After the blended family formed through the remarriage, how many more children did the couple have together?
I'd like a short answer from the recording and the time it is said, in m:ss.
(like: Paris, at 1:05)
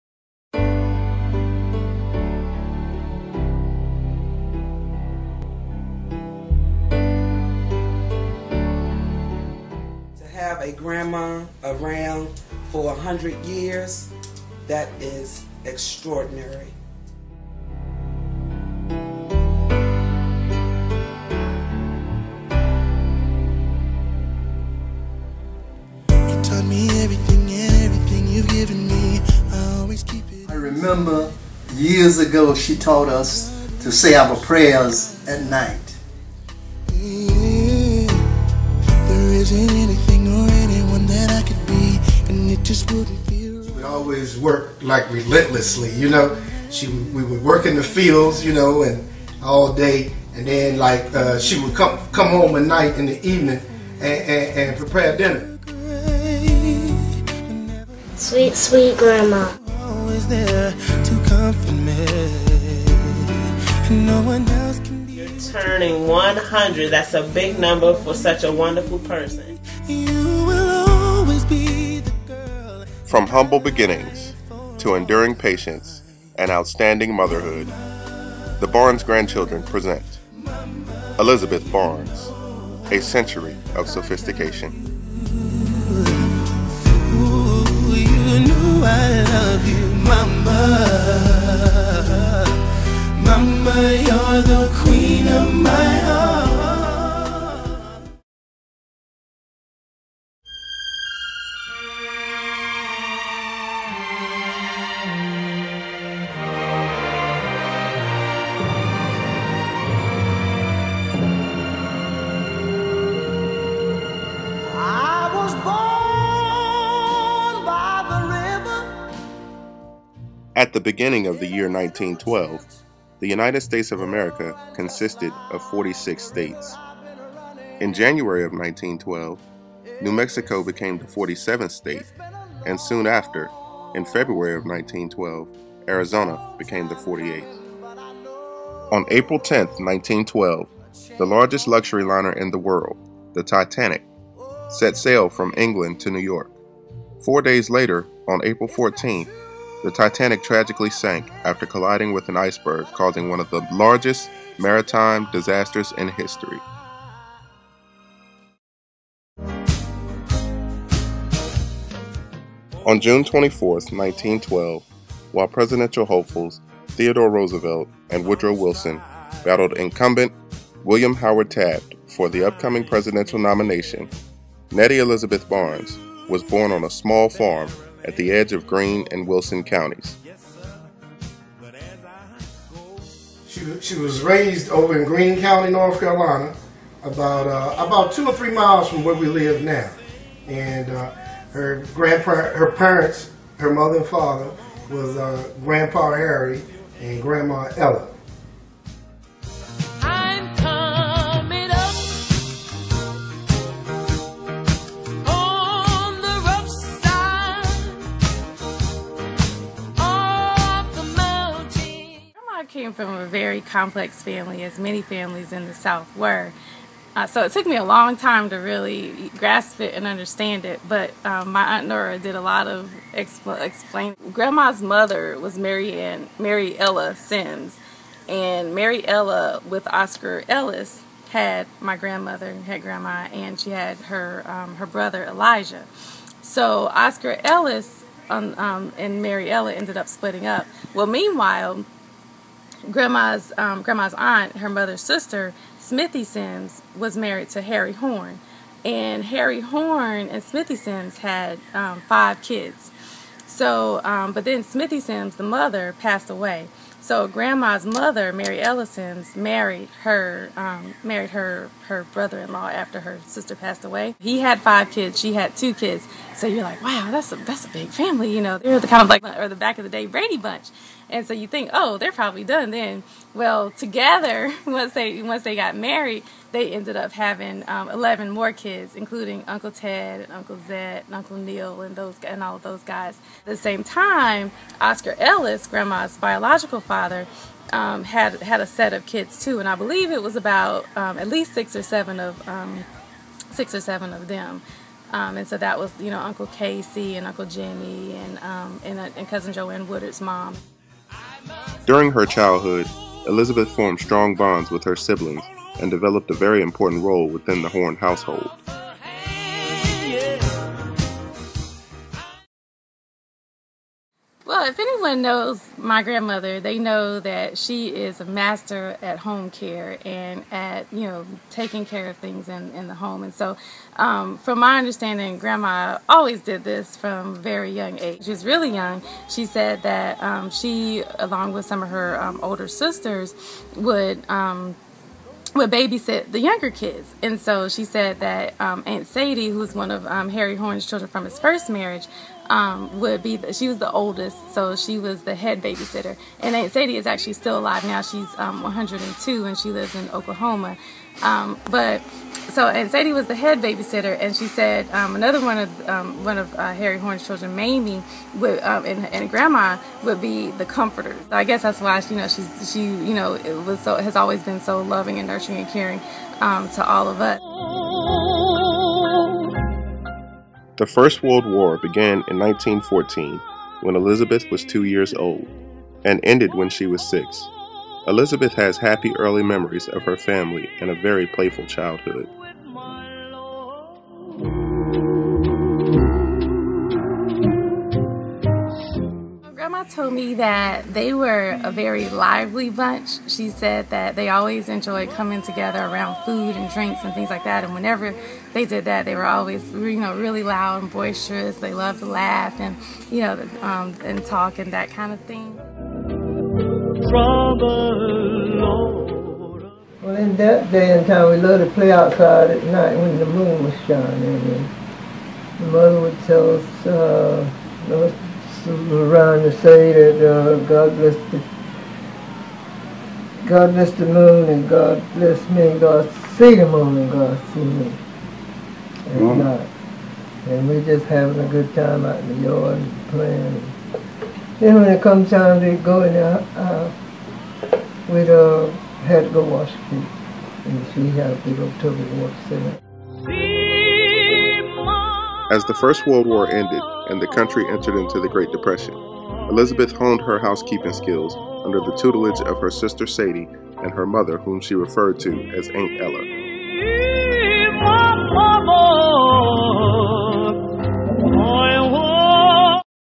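11, at 4:37.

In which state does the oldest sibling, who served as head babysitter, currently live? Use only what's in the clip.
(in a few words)
Oklahoma.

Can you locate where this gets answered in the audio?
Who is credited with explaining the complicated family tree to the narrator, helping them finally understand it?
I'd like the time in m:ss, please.
3:41.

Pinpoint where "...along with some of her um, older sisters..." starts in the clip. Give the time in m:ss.
5:31.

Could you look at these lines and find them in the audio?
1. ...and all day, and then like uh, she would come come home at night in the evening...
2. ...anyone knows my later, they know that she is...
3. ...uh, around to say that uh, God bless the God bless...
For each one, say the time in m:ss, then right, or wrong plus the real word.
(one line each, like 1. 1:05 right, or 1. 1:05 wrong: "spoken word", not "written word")
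1. 0:48 right
2. 5:14 wrong: "grandmother", not "later"
3. 6:56 right.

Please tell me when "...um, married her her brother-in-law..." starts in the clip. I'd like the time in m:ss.
4:20.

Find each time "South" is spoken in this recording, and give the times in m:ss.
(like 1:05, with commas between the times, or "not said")
3:35.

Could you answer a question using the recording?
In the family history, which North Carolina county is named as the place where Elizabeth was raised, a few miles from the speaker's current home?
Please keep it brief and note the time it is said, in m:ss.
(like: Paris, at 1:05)
Greene County, at 3:05.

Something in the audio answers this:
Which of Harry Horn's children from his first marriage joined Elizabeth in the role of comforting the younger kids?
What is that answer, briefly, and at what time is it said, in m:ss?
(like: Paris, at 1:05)
Mamie, at 5:57.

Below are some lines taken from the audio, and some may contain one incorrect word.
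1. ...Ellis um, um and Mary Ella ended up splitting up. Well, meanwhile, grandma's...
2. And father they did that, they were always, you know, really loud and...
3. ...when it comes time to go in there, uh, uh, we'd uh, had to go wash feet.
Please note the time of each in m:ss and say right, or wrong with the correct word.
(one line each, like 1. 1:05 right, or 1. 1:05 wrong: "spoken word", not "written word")
1. 3:57 right
2. 6:37 wrong: "whenever", not "father"
3. 7:14 right.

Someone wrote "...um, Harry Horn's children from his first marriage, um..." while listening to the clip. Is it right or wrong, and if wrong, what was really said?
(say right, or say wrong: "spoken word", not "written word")
right.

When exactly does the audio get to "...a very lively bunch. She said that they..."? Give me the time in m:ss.
6:31.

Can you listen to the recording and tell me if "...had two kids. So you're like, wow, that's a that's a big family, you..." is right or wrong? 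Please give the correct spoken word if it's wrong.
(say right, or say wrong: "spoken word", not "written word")
right.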